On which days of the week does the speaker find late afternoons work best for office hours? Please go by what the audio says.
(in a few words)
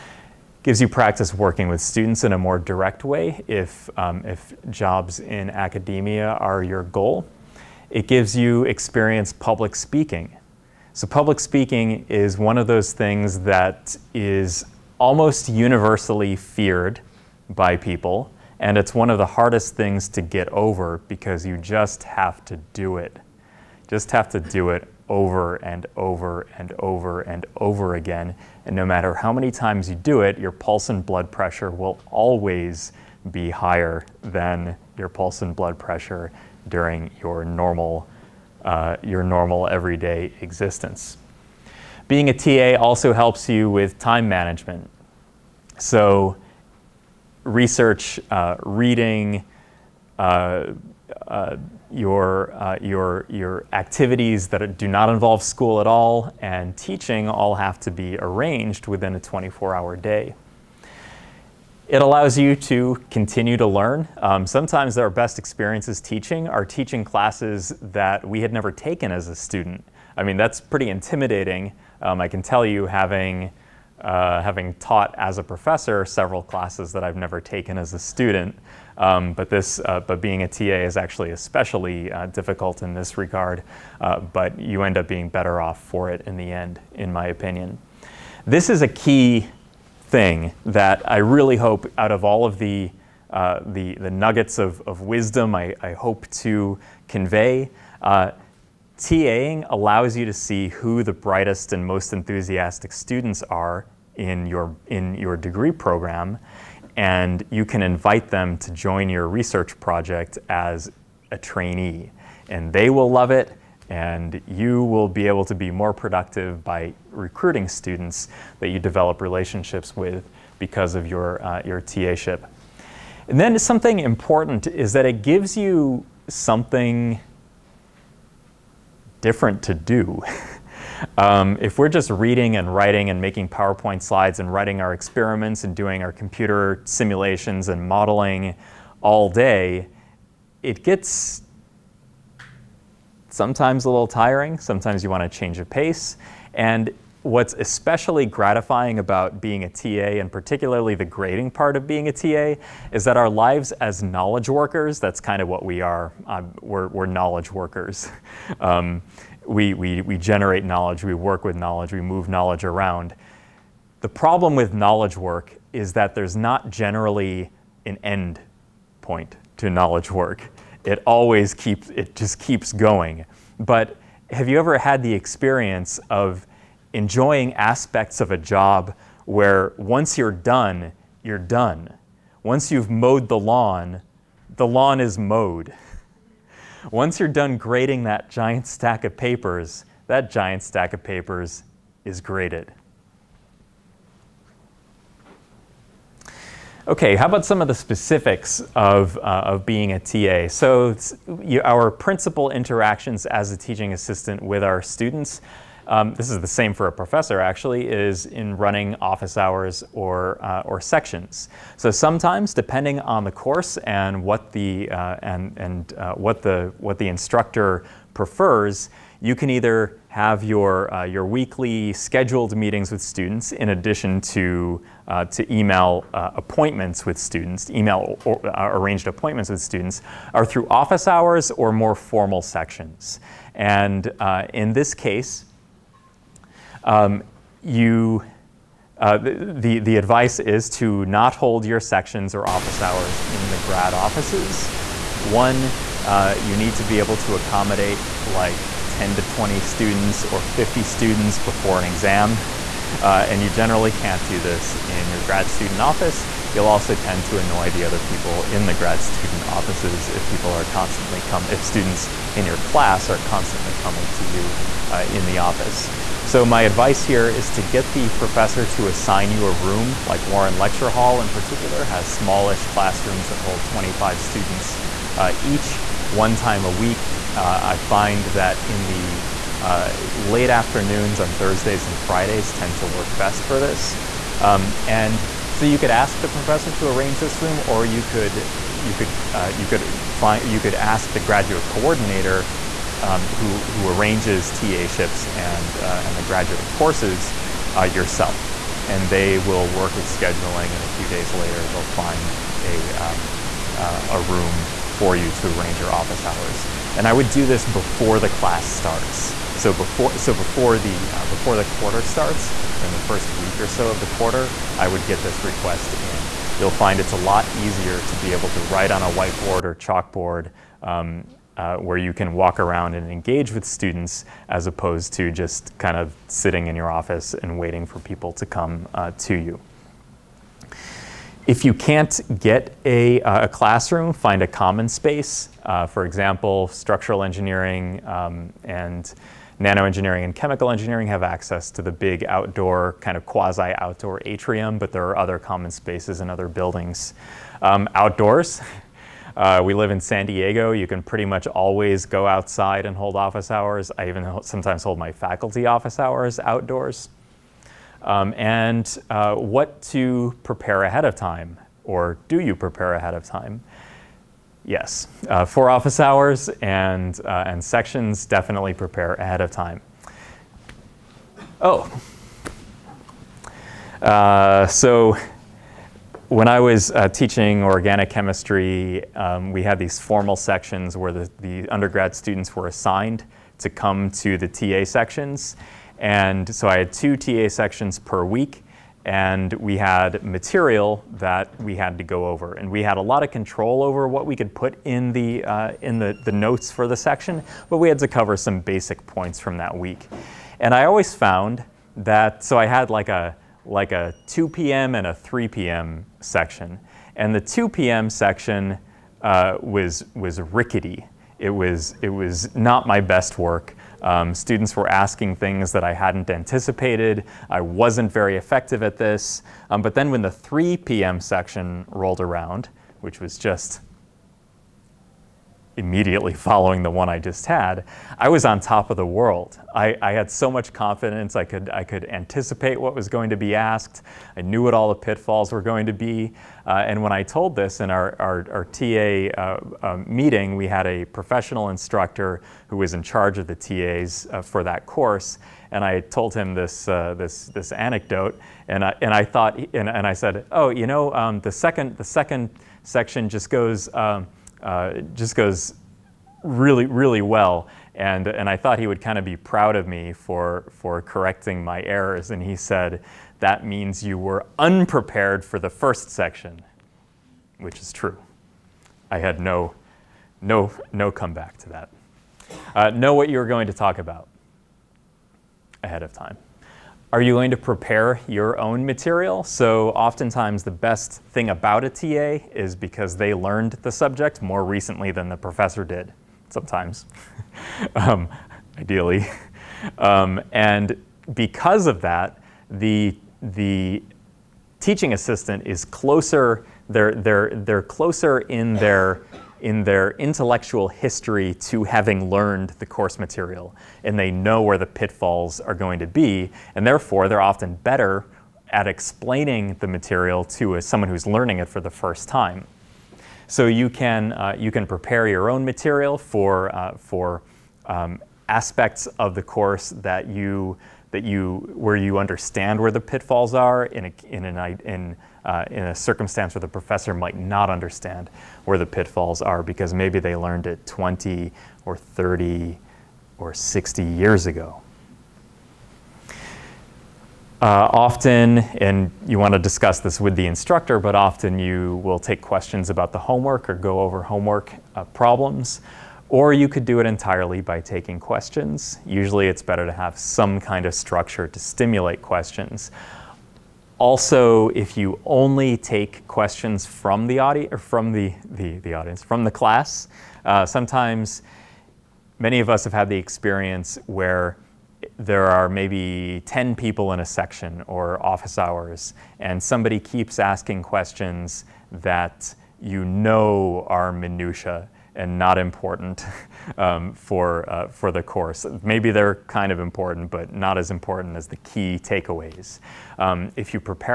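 Thursdays and Fridays.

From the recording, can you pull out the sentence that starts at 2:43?
The problem with knowledge work is that there's not generally an end point to knowledge work.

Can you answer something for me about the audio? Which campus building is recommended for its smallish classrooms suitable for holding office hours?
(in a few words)
Warren Lecture Hall.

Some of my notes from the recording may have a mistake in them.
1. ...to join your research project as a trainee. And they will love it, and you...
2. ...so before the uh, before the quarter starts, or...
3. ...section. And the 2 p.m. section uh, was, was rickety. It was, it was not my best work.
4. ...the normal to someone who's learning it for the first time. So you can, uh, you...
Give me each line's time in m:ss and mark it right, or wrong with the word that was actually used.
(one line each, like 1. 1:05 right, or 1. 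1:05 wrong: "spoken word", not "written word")
1. 1:48 right
2. 5:10 right
3. 6:46 right
4. 8:29 wrong: "material", not "normal".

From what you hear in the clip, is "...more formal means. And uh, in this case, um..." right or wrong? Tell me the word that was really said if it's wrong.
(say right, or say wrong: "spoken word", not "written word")
wrong: "sections", not "means".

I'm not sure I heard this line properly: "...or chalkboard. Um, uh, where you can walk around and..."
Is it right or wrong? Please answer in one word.
right.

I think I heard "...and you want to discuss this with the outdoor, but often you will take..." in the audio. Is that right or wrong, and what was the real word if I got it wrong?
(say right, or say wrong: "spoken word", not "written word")
wrong: "instructor", not "outdoor".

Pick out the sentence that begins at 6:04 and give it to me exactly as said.
Yes, uh, for office hours and, uh, and sections, definitely prepare ahead of time.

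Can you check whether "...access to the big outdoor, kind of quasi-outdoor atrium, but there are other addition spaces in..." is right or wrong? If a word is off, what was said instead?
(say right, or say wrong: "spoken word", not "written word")
wrong: "common", not "addition".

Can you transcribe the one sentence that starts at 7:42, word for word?
And he said, that means you were unprepared for the first section, which is true.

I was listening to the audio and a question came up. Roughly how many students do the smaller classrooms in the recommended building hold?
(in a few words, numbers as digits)
25.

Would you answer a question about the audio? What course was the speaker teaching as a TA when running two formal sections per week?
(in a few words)
Organic chemistry.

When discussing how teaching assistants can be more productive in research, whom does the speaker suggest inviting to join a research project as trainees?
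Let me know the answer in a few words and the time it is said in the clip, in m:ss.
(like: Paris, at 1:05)
Brightest and most enthusiastic students, at 1:41.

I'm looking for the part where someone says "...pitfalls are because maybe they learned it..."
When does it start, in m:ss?
8:48.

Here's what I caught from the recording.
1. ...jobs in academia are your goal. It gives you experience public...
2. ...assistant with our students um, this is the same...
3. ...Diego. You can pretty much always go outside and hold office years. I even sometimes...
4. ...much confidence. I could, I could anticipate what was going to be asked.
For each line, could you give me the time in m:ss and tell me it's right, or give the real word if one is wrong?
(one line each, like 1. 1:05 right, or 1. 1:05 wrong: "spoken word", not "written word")
1. 0:04 right
2. 3:23 right
3. 5:50 wrong: "hours", not "years"
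4. 7:10 right.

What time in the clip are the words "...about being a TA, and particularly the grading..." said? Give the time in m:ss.
2:28.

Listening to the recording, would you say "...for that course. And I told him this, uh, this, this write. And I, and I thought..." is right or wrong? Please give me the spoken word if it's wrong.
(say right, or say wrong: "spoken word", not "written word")
wrong: "anecdote", not "write".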